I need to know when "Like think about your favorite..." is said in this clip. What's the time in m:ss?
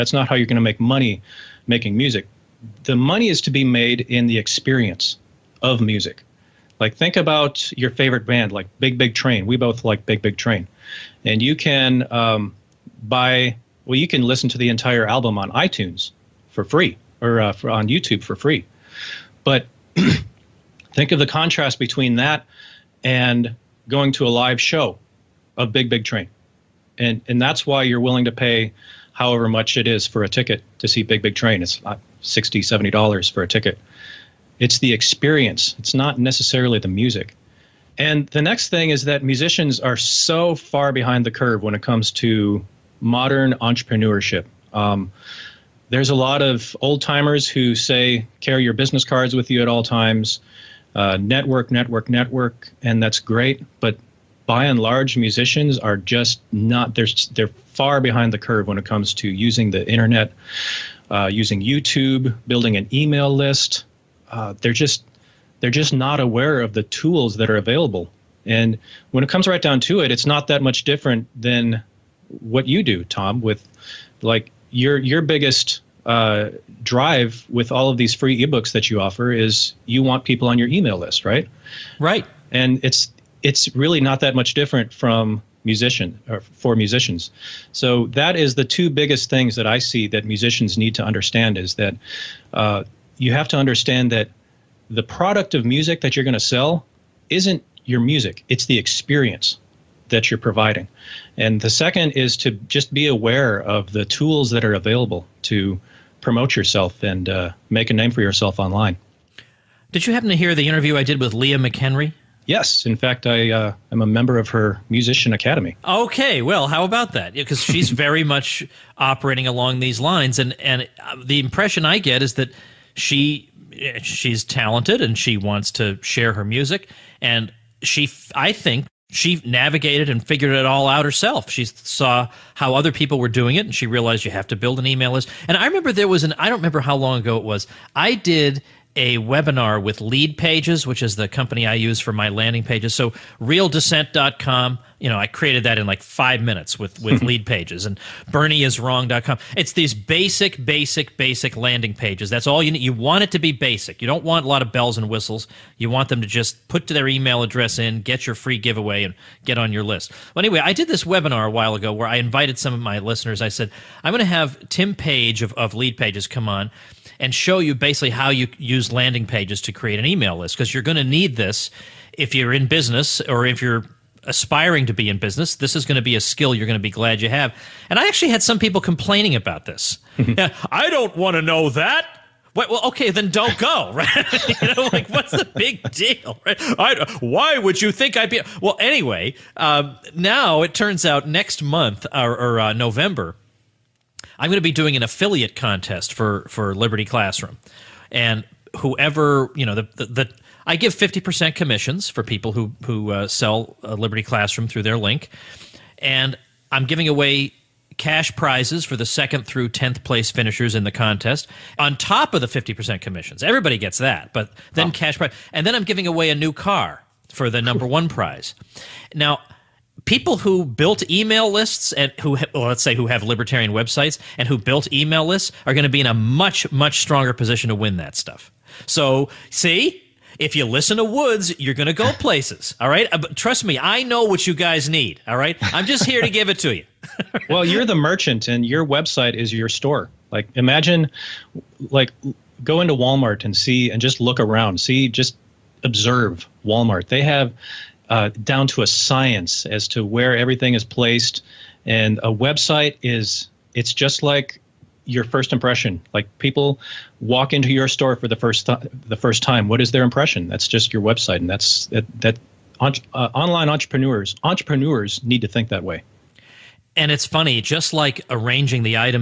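0:06.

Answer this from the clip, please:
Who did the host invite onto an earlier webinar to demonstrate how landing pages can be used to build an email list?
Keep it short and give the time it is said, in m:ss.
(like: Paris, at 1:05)
Tim Paige, at 2:44.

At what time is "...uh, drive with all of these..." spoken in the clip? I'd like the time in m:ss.
1:16.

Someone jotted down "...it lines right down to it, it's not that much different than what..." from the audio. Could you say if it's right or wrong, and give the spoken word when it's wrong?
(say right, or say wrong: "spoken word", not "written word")
wrong: "comes", not "lines".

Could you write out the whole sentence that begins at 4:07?
They have uh, down to a science as to where everything is placed.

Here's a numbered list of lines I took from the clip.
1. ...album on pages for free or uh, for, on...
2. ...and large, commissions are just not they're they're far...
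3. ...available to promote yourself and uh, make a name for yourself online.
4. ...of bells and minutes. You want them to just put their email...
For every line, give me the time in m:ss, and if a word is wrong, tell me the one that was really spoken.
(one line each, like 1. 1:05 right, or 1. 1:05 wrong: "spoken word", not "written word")
1. 0:15 wrong: "iTunes", not "pages"
2. 0:54 wrong: "musicians", not "commissions"
3. 1:44 right
4. 2:34 wrong: "whistles", not "minutes".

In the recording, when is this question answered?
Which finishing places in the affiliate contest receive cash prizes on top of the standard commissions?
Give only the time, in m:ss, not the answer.
3:29.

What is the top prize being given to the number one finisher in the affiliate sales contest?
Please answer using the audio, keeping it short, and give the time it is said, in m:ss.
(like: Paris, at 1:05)
A new car, at 3:36.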